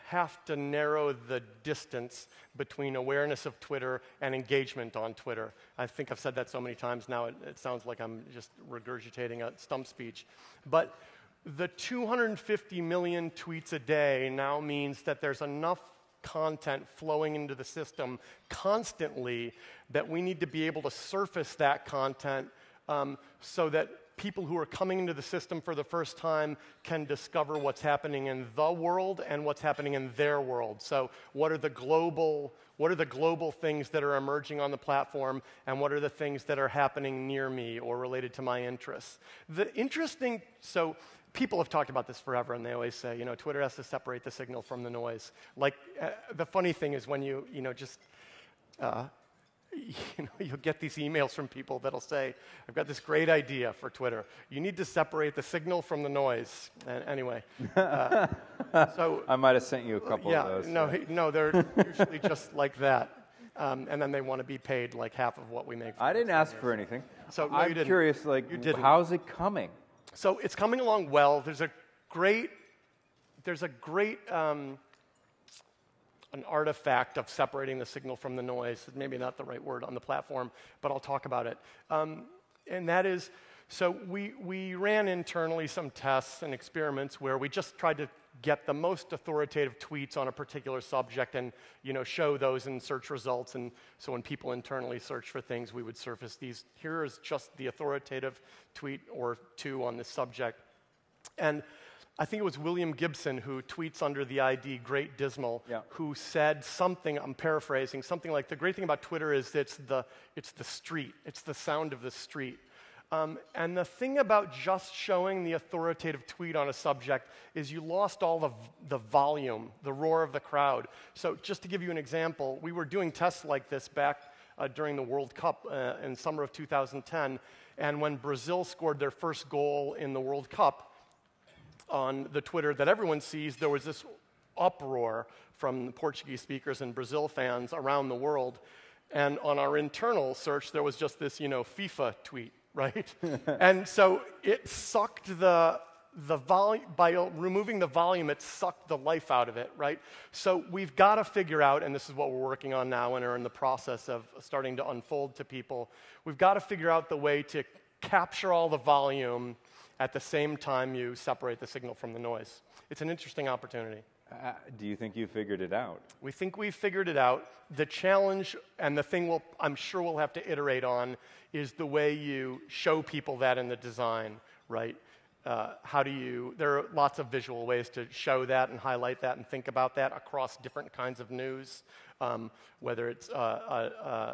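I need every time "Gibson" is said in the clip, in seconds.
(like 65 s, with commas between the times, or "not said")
102 s.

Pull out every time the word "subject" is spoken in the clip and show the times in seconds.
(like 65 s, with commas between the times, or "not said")
90 s, 100 s, 116 s.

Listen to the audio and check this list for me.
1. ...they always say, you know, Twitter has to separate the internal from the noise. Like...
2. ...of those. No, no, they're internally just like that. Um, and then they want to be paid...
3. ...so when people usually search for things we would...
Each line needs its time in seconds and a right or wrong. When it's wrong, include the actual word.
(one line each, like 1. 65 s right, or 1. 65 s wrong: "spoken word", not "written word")
1. 42 s wrong: "signal", not "internal"
2. 60 s wrong: "usually", not "internally"
3. 93 s wrong: "internally", not "usually".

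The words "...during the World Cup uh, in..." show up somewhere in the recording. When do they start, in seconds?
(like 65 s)
124 s.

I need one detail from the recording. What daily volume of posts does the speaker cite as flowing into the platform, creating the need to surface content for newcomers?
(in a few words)
250 million tweets.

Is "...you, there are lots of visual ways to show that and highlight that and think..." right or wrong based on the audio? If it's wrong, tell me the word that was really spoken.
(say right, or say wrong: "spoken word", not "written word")
right.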